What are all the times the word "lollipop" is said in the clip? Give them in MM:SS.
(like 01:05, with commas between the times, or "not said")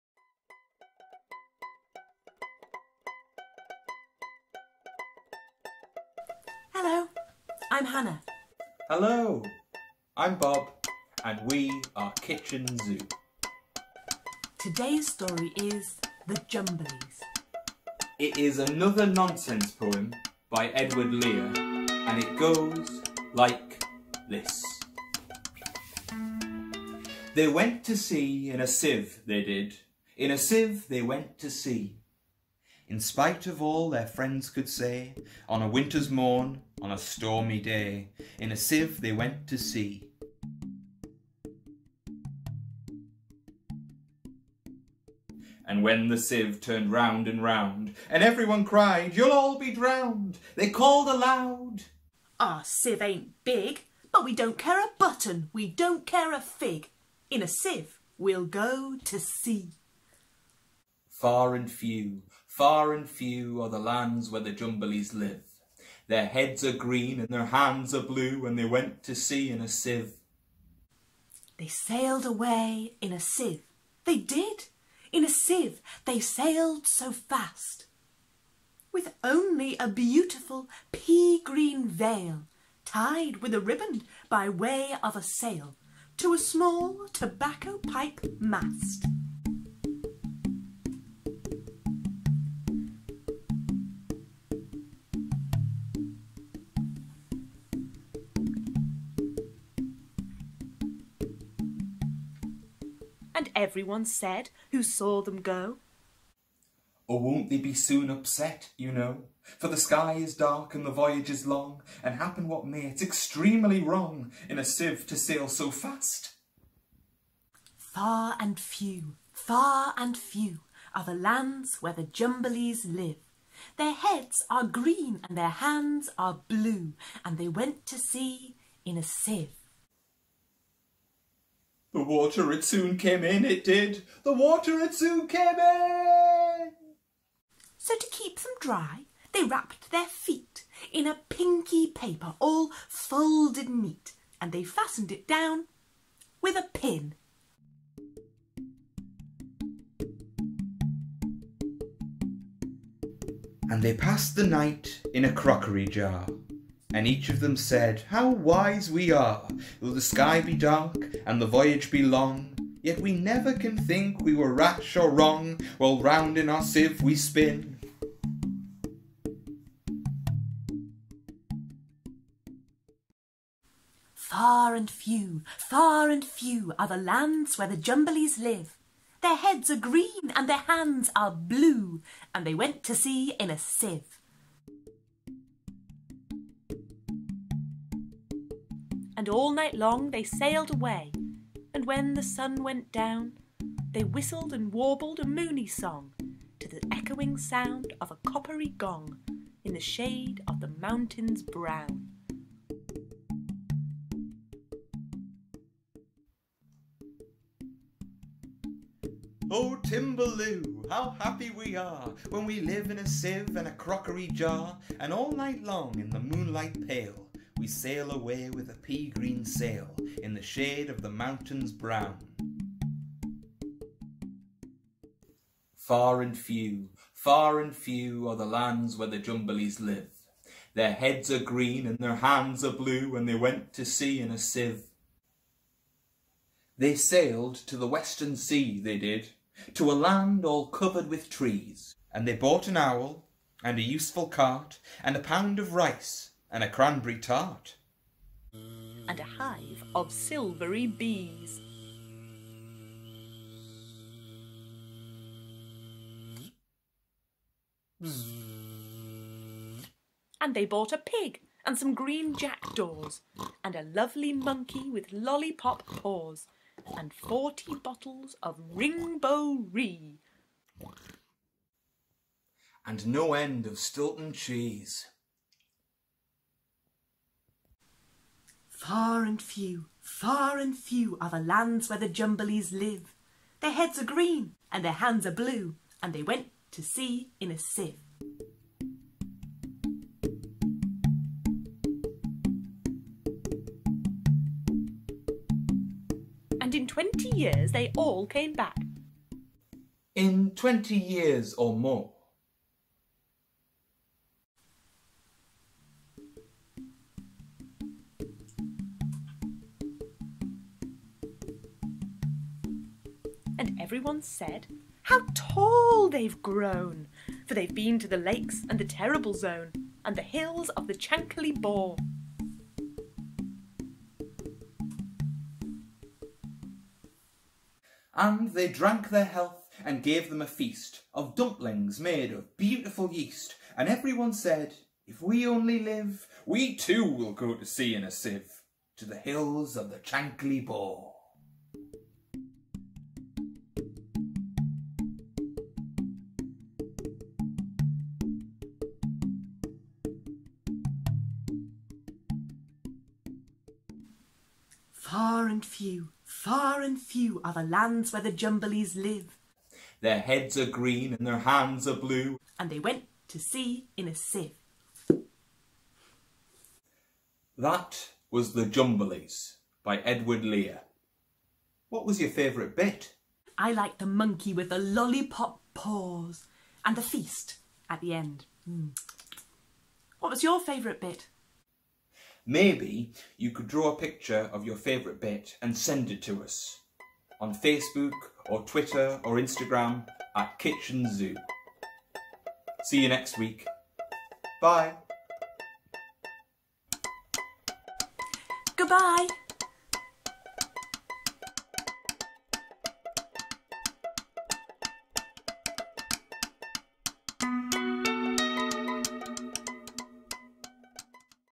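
04:25, 06:14.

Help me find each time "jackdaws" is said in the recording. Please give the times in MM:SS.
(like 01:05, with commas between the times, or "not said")
04:22.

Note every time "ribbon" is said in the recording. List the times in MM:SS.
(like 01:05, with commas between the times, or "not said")
01:23.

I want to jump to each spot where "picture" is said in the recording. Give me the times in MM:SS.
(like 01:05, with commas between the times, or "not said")
06:23.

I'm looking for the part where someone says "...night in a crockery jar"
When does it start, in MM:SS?
02:34.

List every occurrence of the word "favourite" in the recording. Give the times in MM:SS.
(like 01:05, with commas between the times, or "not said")
06:12, 06:20, 06:24.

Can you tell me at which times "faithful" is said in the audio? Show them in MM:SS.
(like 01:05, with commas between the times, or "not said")
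not said.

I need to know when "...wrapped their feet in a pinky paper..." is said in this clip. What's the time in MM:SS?
02:19.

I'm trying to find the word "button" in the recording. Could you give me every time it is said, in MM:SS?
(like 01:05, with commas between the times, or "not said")
00:54.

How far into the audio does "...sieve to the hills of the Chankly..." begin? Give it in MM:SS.
05:38.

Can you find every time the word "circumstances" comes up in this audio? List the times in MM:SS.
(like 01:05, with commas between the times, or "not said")
not said.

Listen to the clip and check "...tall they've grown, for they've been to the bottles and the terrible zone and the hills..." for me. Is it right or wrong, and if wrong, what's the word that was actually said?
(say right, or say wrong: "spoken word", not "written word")
wrong: "lakes", not "bottles".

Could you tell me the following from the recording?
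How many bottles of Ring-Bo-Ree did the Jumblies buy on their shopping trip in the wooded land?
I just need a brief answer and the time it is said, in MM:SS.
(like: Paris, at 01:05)
40, at 04:27.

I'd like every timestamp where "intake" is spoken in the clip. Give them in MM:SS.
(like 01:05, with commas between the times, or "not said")
not said.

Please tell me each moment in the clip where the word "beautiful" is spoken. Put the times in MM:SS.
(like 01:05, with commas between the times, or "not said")
01:19, 05:32.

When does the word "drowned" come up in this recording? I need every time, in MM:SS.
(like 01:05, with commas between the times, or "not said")
00:49.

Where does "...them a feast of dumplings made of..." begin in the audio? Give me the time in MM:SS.
05:30.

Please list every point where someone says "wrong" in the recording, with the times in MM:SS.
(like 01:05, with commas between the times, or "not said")
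01:53, 02:45.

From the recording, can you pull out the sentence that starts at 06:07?
That was The Jumblies by Edward Lear.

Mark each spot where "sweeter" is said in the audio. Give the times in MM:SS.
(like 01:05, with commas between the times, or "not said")
not said.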